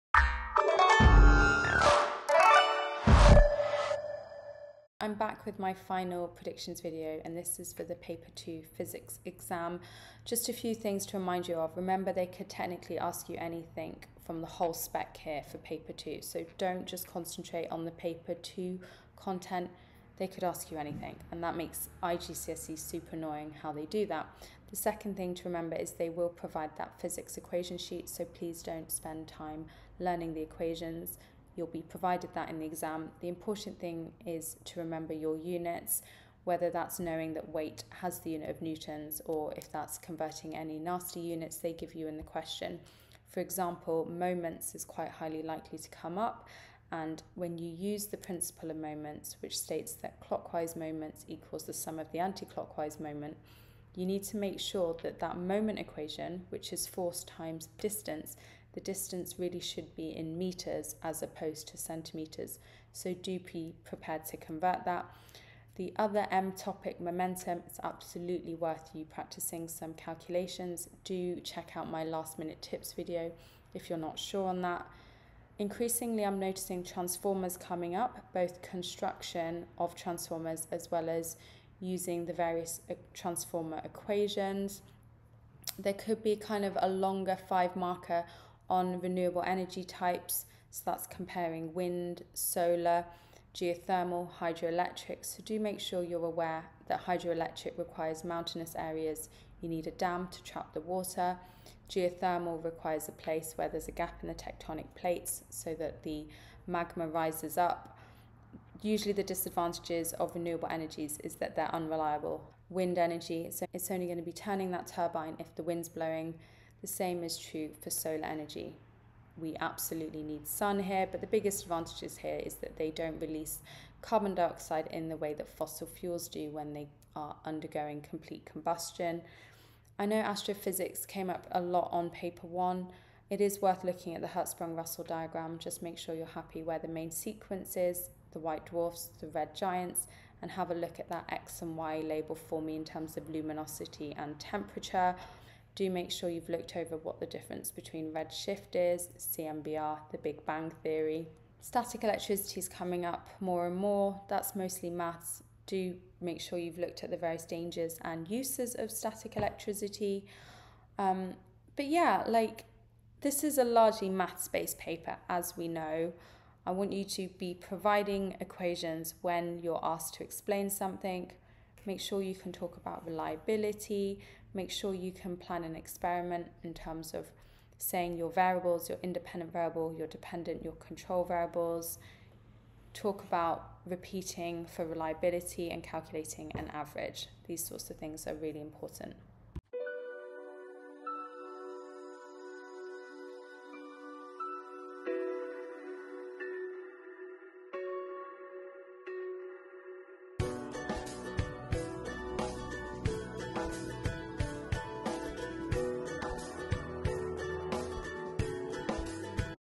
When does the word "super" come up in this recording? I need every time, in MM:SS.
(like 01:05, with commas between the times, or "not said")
00:22.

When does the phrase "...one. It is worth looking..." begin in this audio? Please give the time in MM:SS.
02:12.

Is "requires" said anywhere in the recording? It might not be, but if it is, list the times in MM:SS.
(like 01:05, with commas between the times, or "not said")
01:37, 01:42.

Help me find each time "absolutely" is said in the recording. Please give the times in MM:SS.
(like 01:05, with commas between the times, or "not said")
01:07, 01:59.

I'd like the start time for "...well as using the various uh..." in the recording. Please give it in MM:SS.
01:20.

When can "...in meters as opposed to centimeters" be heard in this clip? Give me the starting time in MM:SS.
01:00.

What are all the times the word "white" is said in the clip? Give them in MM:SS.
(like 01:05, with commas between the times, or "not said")
02:18.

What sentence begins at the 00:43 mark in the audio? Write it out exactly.
For example, moments is quite highly likely to come up.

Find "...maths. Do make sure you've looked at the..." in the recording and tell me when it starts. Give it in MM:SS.
02:34.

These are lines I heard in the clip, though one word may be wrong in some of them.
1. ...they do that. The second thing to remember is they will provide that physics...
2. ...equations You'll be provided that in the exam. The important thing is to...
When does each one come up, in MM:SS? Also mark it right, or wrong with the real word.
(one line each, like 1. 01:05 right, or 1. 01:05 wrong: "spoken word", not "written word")
1. 00:23 right
2. 00:30 right.